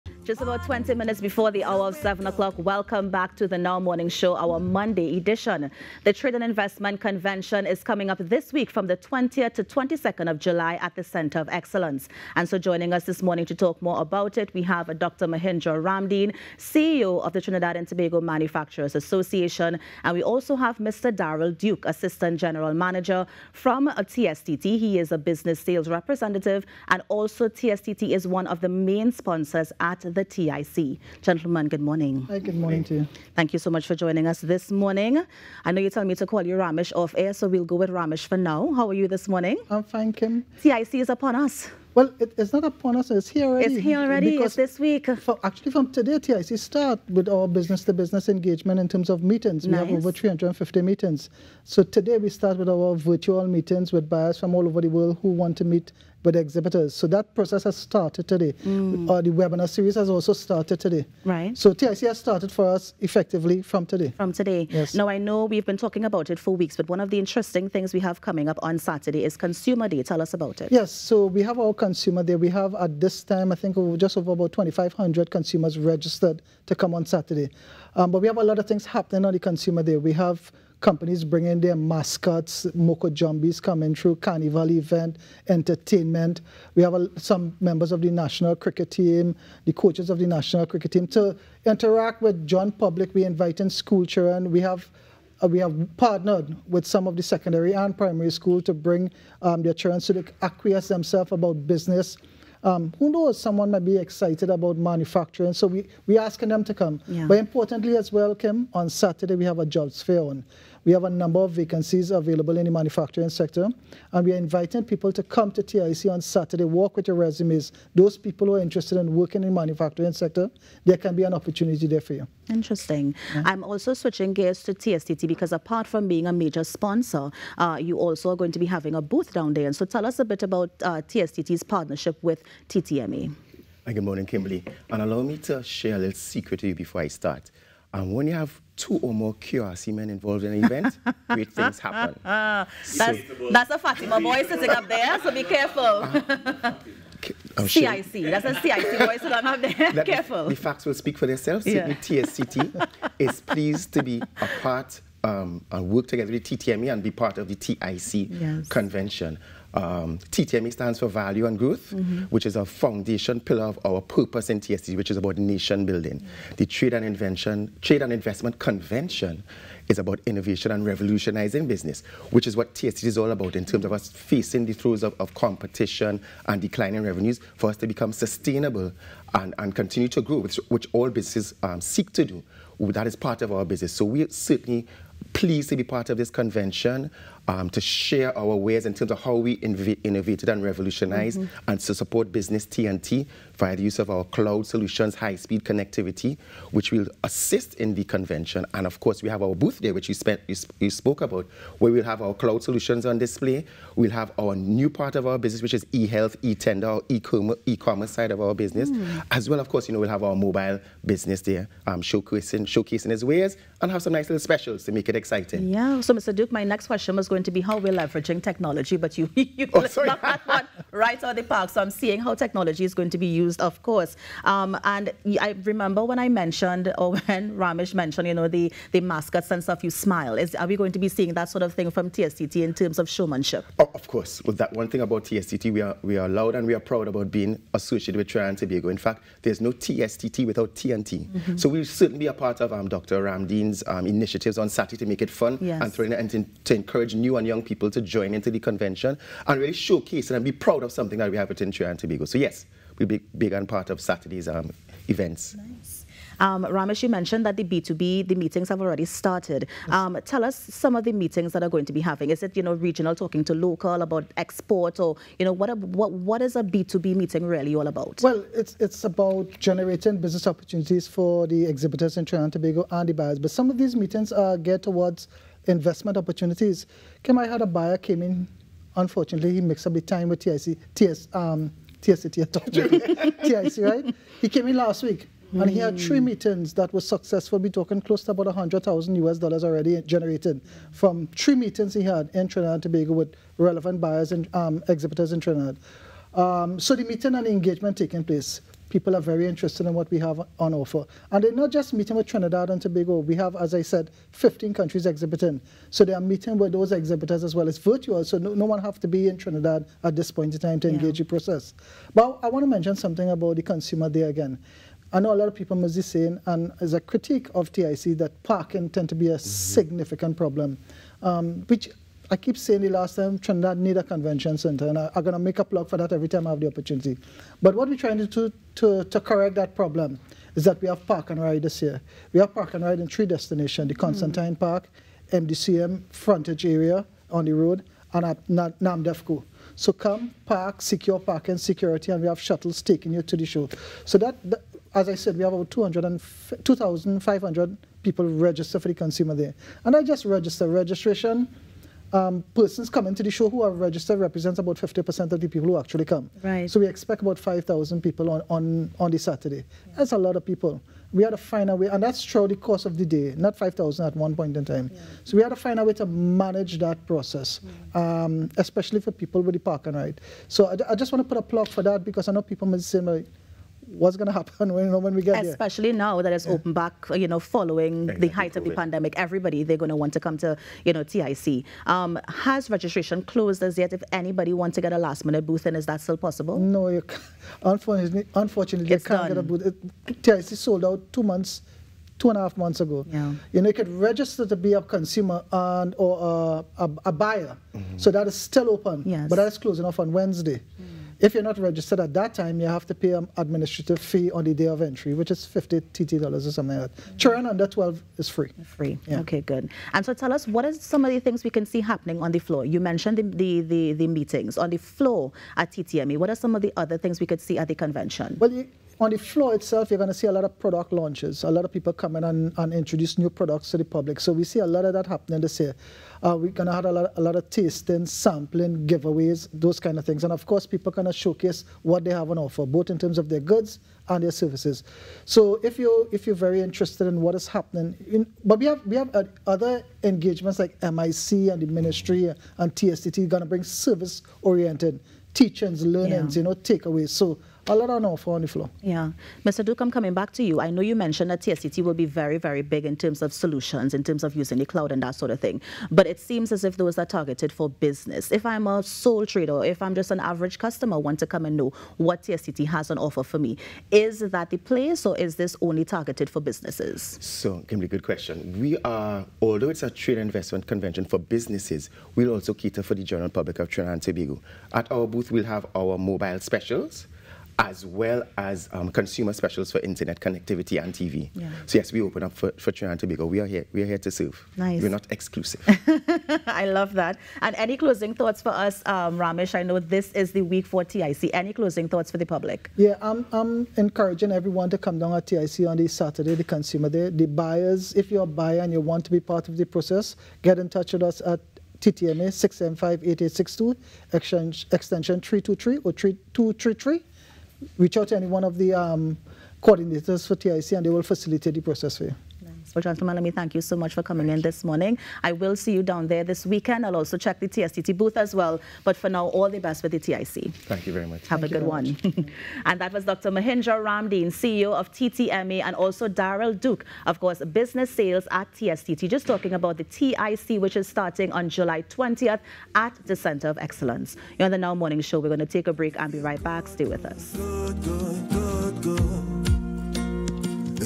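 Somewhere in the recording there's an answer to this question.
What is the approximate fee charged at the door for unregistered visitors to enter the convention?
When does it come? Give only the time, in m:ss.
6:45.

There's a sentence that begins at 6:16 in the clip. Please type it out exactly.
open back, you know, following exactly.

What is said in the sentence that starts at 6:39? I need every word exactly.
but that is closing off on Wednesday.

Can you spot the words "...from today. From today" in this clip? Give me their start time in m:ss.
1:03.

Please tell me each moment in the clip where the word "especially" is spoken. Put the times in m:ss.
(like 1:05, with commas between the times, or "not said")
6:08, 6:15.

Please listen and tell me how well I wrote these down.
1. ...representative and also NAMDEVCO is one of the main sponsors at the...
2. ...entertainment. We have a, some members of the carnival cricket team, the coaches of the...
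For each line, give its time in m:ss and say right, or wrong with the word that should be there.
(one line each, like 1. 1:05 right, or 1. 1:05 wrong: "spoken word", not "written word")
1. 0:25 wrong: "TSTT", not "NAMDEVCO"
2. 1:25 wrong: "national", not "carnival".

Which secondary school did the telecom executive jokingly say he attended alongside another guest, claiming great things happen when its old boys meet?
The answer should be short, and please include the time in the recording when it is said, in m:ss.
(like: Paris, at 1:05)
QRC, at 2:19.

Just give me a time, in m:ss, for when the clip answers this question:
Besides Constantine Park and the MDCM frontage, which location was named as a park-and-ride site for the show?
5:38.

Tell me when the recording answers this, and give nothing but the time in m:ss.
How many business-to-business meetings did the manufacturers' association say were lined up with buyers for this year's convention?
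0:49.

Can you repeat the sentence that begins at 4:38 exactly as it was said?
Unfortunately, he mixed up the time with TIC, TS, um, TSTT TIC, right?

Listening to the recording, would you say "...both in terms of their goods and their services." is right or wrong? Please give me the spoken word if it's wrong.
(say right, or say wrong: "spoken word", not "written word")
right.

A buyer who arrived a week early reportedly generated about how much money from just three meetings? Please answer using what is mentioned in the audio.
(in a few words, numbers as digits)
100,000 US dollars.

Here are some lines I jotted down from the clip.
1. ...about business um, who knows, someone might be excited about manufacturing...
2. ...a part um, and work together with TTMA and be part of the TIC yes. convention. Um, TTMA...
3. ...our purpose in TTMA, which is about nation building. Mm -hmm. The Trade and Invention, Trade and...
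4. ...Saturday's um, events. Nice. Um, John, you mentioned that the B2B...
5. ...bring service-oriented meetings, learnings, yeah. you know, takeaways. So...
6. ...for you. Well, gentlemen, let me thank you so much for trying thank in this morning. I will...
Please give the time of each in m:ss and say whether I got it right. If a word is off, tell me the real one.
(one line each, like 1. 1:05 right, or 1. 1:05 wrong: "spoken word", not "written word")
1. 1:41 right
2. 2:34 right
3. 2:43 wrong: "TSD", not "TTMA"
4. 4:13 wrong: "Ramesh", not "John"
5. 7:23 wrong: "teachings", not "meetings"
6. 8:31 wrong: "coming", not "trying".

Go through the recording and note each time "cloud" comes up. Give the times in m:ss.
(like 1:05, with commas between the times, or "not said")
3:14, 3:22, 7:34.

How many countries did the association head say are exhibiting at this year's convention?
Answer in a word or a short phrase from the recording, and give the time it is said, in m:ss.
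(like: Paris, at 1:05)
15, at 5:04.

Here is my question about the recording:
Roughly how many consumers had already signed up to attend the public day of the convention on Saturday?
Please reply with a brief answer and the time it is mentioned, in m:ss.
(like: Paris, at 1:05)
2,500, at 1:14.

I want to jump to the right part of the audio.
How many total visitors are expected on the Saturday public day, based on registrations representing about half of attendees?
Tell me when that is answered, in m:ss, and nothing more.
5:57.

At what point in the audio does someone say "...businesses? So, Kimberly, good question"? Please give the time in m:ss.
7:46.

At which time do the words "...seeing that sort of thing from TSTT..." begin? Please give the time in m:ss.
3:51.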